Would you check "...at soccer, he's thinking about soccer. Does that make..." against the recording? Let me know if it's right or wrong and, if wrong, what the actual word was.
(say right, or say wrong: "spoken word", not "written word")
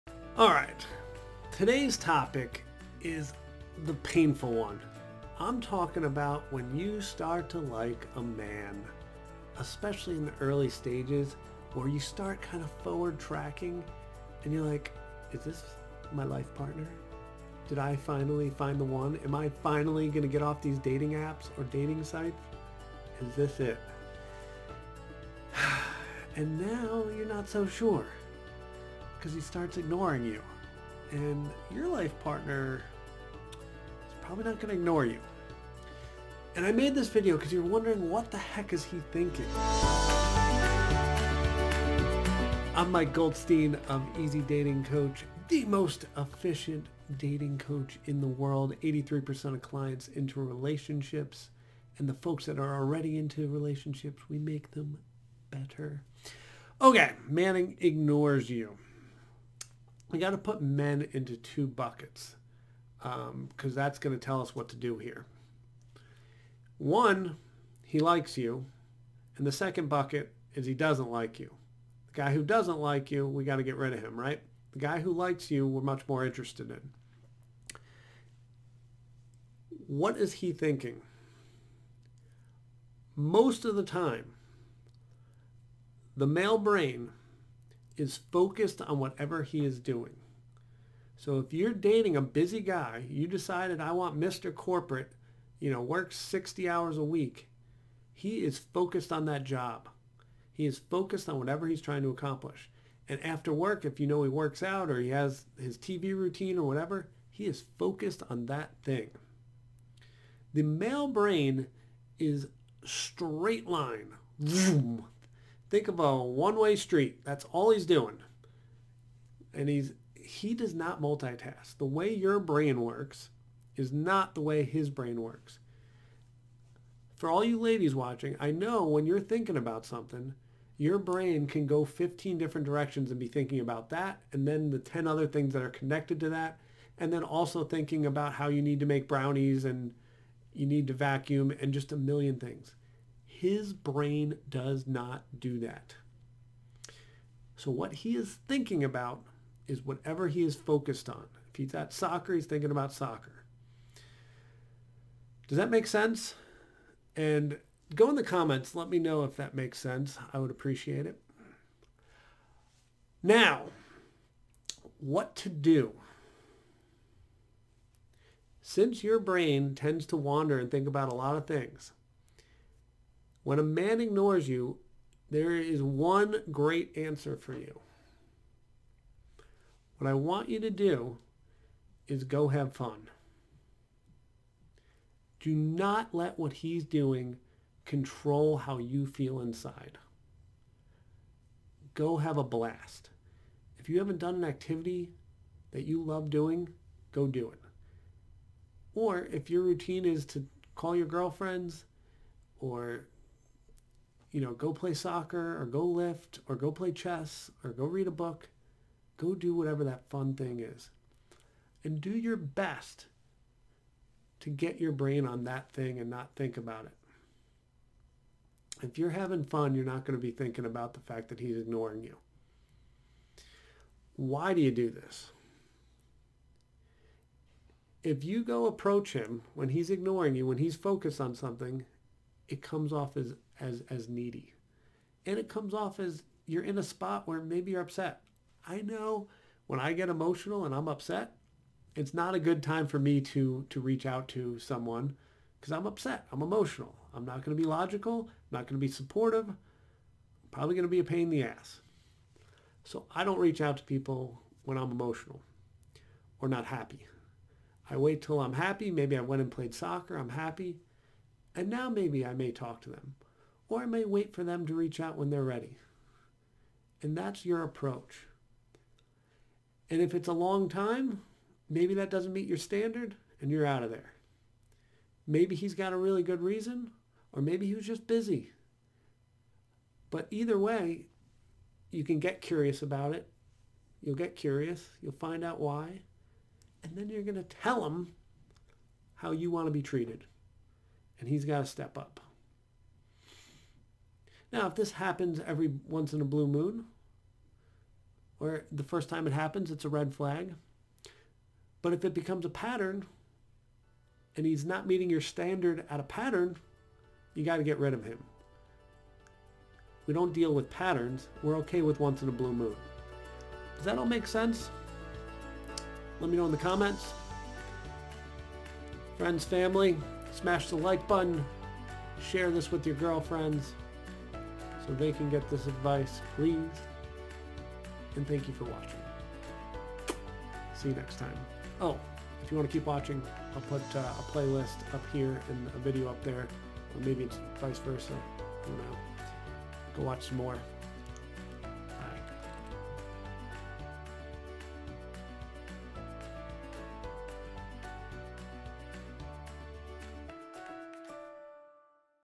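right.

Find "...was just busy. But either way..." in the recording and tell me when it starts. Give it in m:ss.
4:37.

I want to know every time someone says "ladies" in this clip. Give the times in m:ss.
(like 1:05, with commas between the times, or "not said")
2:07.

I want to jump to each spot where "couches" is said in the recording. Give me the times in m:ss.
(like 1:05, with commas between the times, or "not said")
not said.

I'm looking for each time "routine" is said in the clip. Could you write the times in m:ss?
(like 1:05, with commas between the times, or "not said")
1:46, 3:19.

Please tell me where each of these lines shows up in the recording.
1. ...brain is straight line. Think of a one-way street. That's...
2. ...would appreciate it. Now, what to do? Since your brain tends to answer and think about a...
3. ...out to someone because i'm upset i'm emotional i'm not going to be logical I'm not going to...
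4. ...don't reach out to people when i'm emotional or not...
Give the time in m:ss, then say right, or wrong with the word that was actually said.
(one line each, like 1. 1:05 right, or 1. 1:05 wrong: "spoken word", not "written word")
1. 1:51 right
2. 2:40 wrong: "wander", not "answer"
3. 4:04 right
4. 4:13 right.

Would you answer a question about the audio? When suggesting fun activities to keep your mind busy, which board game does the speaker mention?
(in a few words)
Chess.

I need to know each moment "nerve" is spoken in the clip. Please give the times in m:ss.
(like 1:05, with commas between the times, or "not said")
not said.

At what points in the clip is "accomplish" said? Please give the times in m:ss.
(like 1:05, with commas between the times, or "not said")
1:42.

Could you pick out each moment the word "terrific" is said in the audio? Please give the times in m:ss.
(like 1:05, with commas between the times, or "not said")
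not said.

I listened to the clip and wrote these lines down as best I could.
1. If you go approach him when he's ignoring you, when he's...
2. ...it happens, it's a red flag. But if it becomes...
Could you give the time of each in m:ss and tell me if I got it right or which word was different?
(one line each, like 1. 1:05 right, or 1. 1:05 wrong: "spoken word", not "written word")
1. 3:48 right
2. 4:59 right.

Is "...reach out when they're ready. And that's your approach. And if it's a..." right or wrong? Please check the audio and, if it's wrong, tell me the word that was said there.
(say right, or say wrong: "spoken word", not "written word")
right.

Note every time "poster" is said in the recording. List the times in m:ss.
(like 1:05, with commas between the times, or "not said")
not said.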